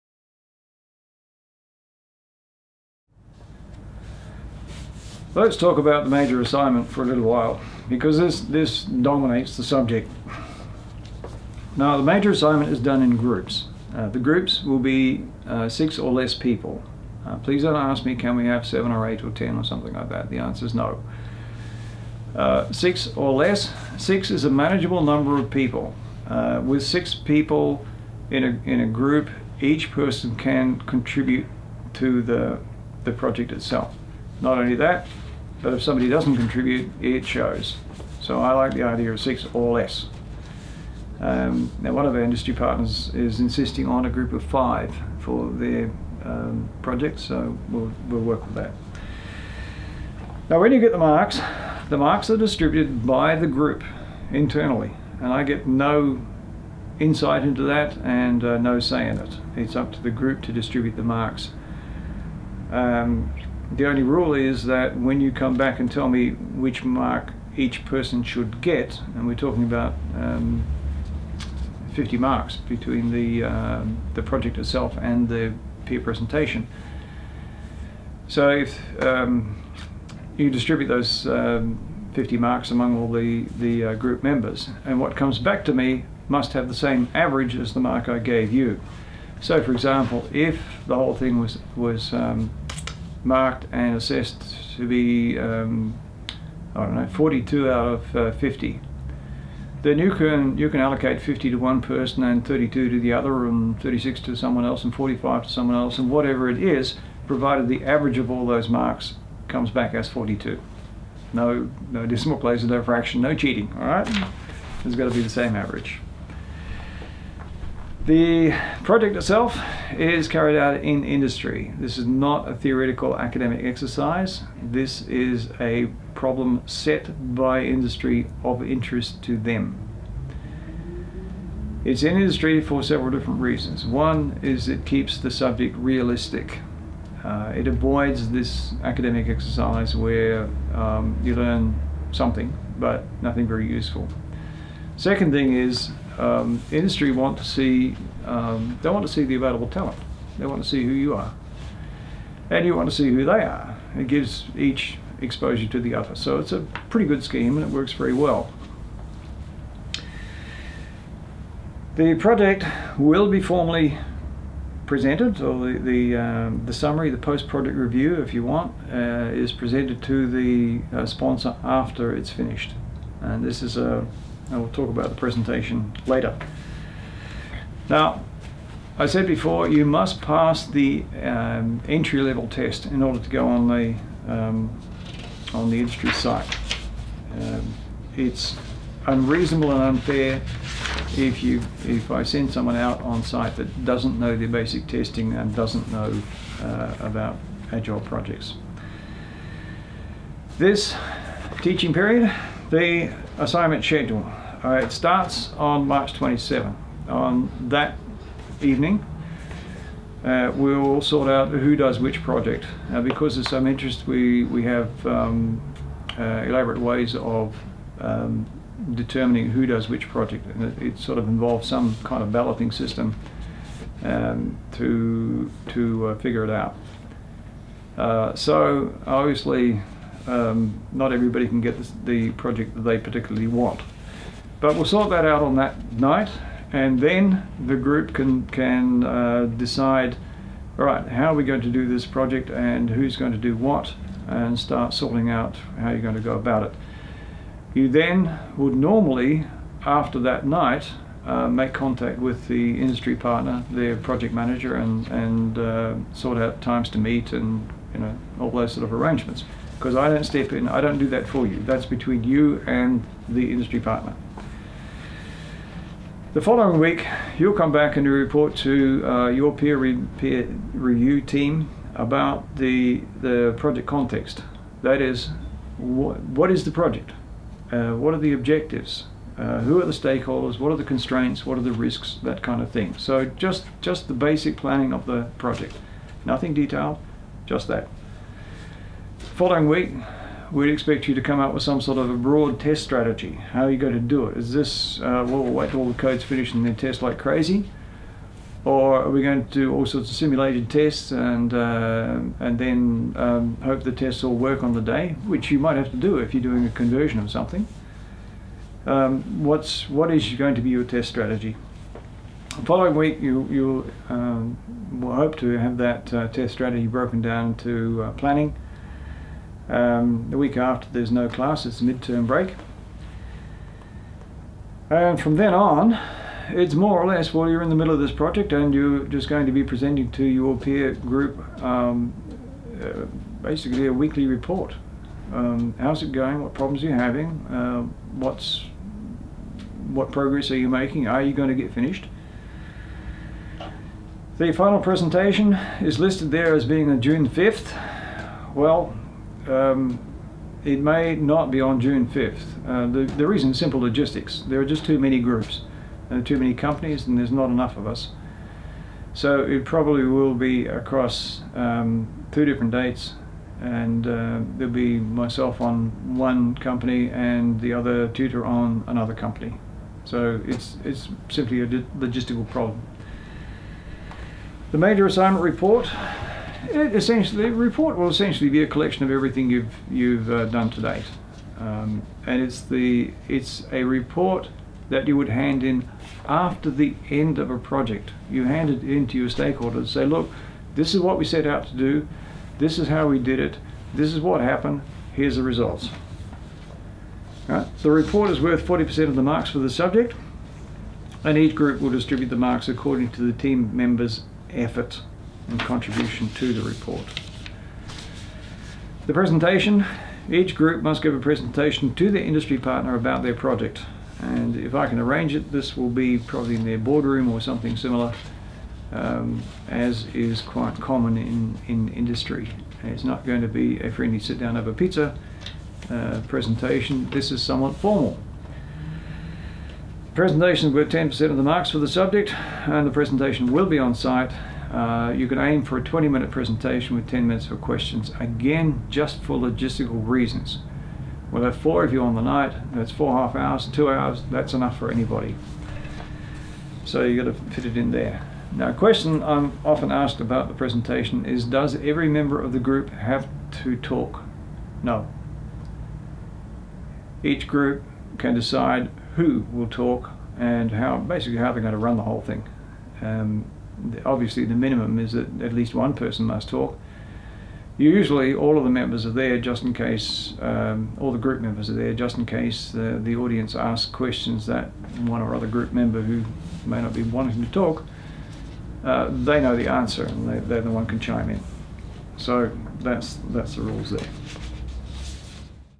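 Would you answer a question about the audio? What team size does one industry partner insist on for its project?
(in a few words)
5.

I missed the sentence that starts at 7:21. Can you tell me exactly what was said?
We'll have four of you on the night, that's four half hours, two hours, that's enough for anybody.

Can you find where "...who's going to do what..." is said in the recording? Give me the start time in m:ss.
4:02.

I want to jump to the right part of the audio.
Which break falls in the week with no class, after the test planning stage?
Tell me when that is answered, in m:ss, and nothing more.
5:21.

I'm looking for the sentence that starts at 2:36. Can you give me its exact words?
So it's a pretty good scheme, and it works very well.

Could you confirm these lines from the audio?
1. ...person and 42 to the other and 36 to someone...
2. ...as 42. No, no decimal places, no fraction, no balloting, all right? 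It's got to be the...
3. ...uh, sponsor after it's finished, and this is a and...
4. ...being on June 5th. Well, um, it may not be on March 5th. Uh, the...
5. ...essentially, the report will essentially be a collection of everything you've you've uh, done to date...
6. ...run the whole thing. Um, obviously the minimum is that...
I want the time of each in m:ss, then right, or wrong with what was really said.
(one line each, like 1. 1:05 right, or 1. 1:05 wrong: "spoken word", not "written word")
1. 1:41 wrong: "32", not "42"
2. 1:49 wrong: "cheating", not "balloting"
3. 2:50 right
4. 5:46 wrong: "June", not "March"
5. 6:16 right
6. 7:41 right.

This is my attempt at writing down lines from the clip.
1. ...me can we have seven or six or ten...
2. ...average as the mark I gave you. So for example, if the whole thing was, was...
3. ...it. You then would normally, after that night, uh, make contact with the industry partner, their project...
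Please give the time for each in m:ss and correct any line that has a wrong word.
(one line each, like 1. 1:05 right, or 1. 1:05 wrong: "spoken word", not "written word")
1. 0:18 wrong: "eight", not "six"
2. 1:27 right
3. 4:06 right.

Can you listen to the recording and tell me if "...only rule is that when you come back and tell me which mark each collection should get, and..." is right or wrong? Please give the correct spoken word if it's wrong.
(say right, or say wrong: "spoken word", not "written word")
wrong: "person", not "collection".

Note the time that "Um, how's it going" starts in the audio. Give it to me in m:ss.
5:35.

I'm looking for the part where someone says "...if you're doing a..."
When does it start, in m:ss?
5:06.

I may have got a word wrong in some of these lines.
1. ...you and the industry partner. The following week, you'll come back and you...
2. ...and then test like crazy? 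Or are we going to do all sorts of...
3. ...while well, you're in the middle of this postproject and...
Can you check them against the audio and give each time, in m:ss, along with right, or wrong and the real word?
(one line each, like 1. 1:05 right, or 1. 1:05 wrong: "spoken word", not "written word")
1. 4:22 right
2. 4:56 right
3. 5:27 wrong: "project", not "postproject".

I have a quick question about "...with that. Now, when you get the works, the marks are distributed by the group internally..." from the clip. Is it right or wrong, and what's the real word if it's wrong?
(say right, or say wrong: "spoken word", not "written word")
wrong: "marks", not "works".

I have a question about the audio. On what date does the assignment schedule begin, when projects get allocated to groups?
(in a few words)
March 27.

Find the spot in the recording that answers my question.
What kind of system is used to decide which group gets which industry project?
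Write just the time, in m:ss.
3:42.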